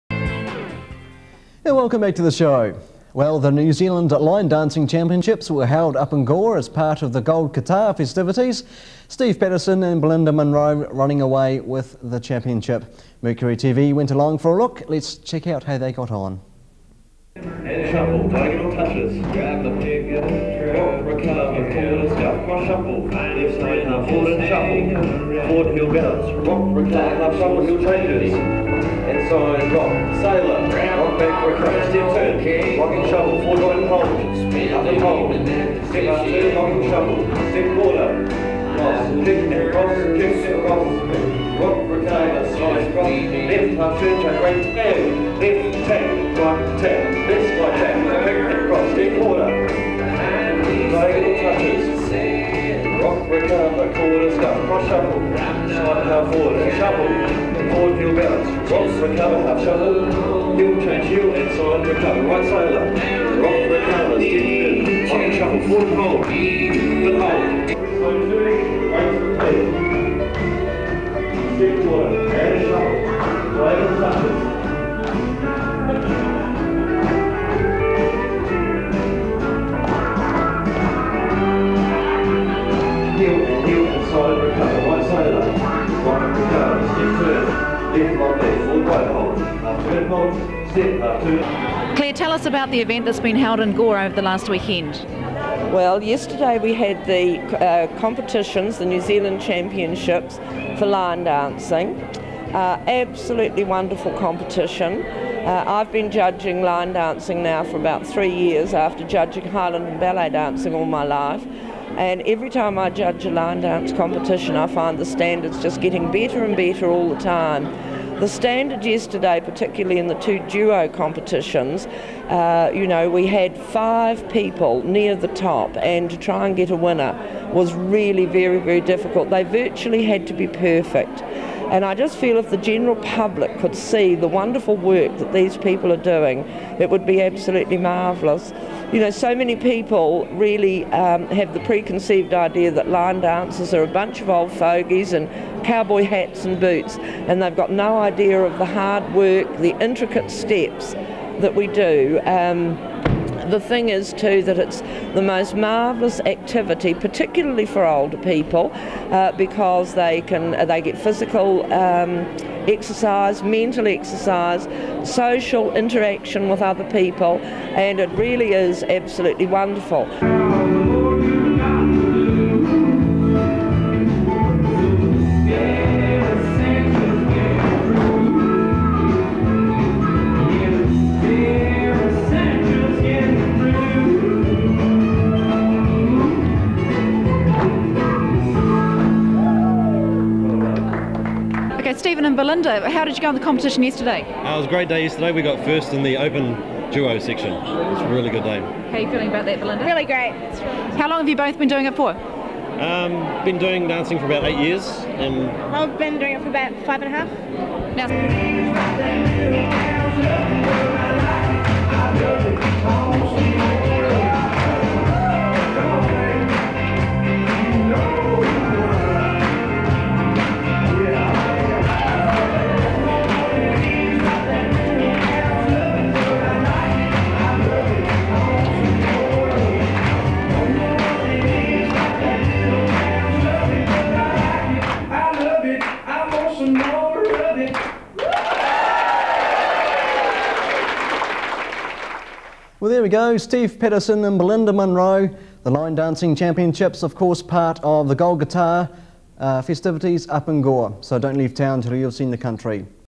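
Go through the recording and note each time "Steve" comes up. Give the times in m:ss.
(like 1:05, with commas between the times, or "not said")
0:09, 4:03.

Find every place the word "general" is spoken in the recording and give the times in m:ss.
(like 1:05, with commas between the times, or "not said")
2:12.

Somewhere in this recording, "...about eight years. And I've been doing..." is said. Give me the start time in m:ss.
3:24.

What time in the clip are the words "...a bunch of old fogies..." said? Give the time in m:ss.
2:23.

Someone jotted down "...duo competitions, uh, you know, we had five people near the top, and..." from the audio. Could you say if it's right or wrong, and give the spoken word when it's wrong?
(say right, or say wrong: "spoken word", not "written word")
right.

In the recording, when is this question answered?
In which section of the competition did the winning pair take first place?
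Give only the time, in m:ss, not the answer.
3:16.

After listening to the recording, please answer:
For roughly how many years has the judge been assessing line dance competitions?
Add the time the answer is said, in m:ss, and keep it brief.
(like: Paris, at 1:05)
3 years, at 1:47.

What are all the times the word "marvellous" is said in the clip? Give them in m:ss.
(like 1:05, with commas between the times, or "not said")
2:17, 2:35.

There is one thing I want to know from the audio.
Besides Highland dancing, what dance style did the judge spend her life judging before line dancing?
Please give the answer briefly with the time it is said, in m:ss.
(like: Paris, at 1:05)
Ballet, at 1:49.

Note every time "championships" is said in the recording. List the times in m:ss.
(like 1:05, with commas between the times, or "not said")
0:04, 0:12, 1:39, 4:06.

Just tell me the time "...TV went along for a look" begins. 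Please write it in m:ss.
0:13.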